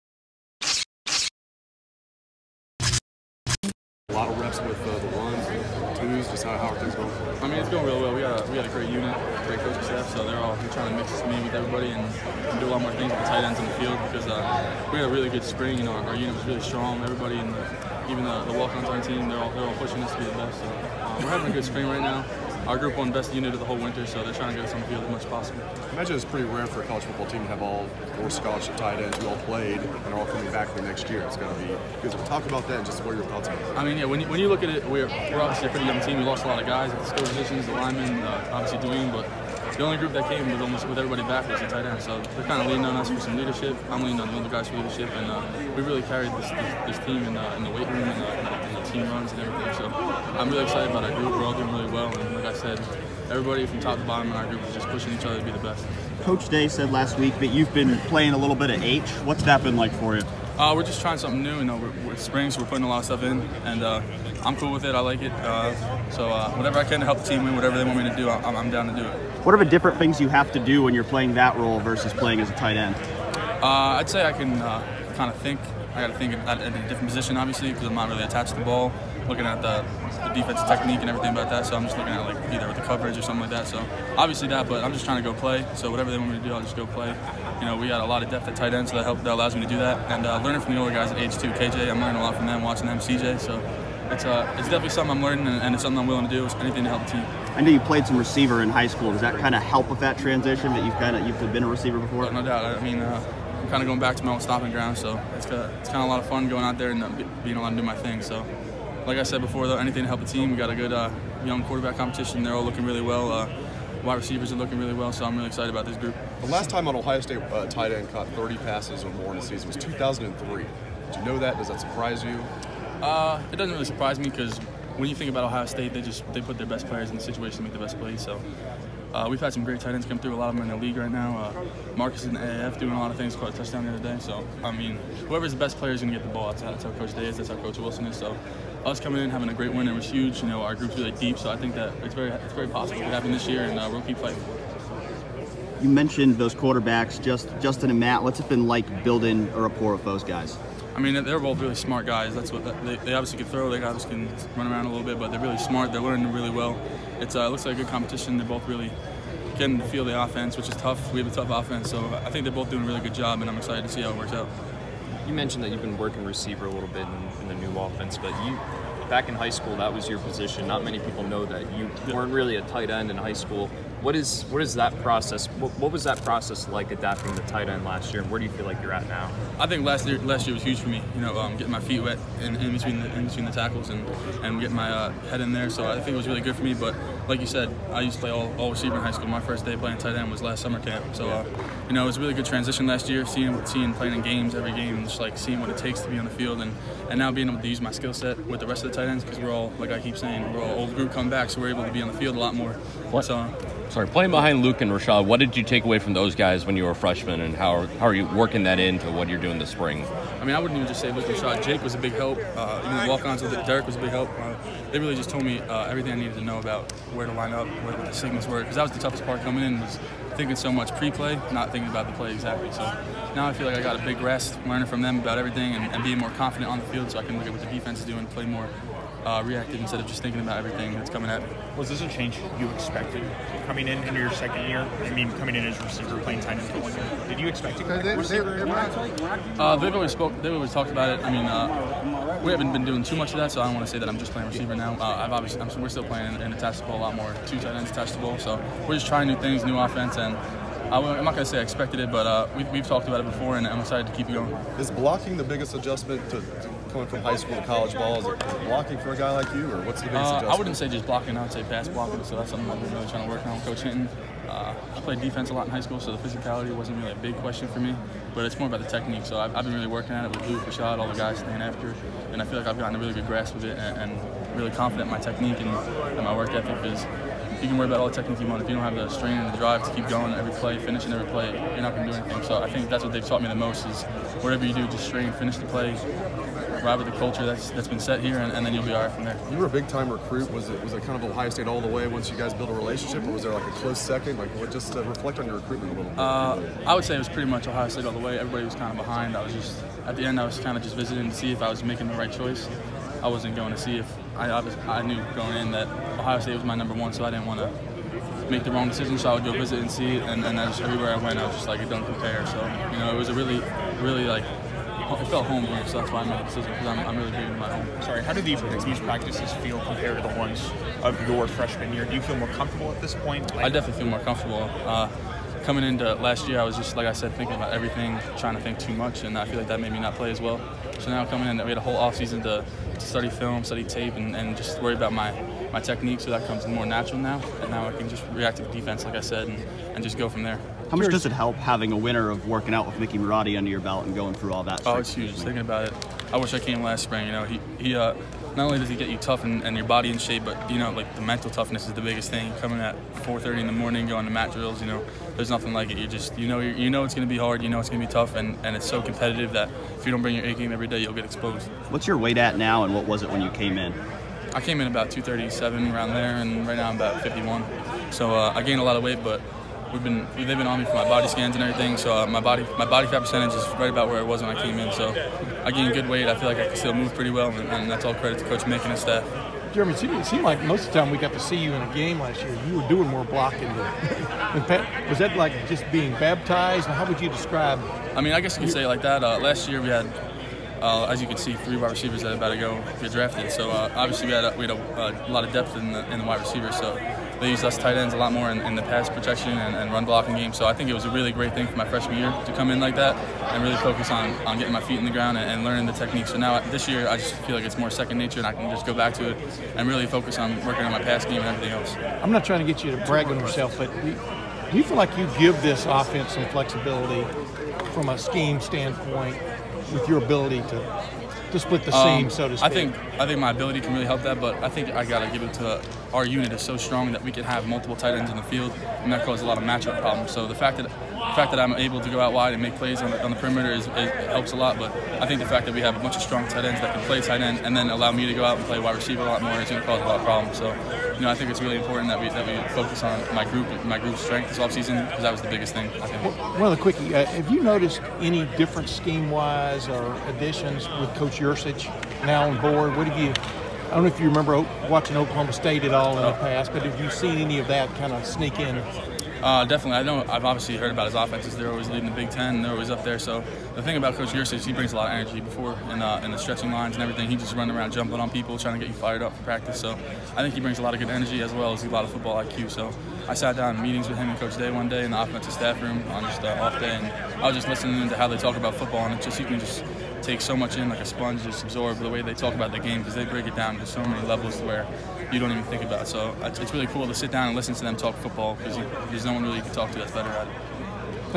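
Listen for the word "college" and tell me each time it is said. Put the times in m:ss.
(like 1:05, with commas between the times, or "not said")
0:26, 4:17.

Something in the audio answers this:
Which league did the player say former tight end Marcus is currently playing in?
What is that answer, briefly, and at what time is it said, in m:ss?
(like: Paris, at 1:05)
AAF, at 2:12.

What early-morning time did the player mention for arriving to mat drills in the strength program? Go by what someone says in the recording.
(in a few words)
4:30.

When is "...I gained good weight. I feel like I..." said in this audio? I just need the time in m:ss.
6:15.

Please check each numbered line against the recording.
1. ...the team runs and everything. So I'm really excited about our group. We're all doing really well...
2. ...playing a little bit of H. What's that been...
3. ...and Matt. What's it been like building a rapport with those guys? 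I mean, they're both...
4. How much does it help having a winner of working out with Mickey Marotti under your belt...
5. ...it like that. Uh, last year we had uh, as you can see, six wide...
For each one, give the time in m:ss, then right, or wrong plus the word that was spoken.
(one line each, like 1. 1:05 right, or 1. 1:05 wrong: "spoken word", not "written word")
1. 0:48 right
2. 0:58 right
3. 2:27 right
4. 5:40 right
5. 6:28 wrong: "three", not "six".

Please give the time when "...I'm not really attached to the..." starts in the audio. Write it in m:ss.
1:17.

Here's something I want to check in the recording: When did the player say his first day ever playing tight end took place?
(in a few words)
Last summer camp.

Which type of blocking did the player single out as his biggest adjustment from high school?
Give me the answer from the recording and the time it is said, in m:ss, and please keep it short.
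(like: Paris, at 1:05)
Pass blocking, at 4:21.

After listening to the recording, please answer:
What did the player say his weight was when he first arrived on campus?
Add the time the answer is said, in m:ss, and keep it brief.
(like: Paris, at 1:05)
237, at 6:05.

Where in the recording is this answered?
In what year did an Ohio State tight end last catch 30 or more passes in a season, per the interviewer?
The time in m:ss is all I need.
1:59.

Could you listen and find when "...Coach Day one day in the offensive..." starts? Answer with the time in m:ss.
7:54.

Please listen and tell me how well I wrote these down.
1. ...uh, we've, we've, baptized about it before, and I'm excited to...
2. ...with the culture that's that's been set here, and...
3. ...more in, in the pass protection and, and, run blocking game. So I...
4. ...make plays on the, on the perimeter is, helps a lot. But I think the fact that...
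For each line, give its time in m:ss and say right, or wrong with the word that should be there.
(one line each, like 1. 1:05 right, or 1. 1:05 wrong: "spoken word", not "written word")
1. 4:12 wrong: "talked", not "baptized"
2. 4:46 right
3. 6:38 right
4. 7:12 right.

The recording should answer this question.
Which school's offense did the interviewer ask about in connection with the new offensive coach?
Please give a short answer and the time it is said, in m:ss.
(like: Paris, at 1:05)
Oklahoma State, at 7:35.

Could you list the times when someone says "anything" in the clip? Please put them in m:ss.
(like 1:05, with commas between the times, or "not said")
1:36, 1:49, 4:42.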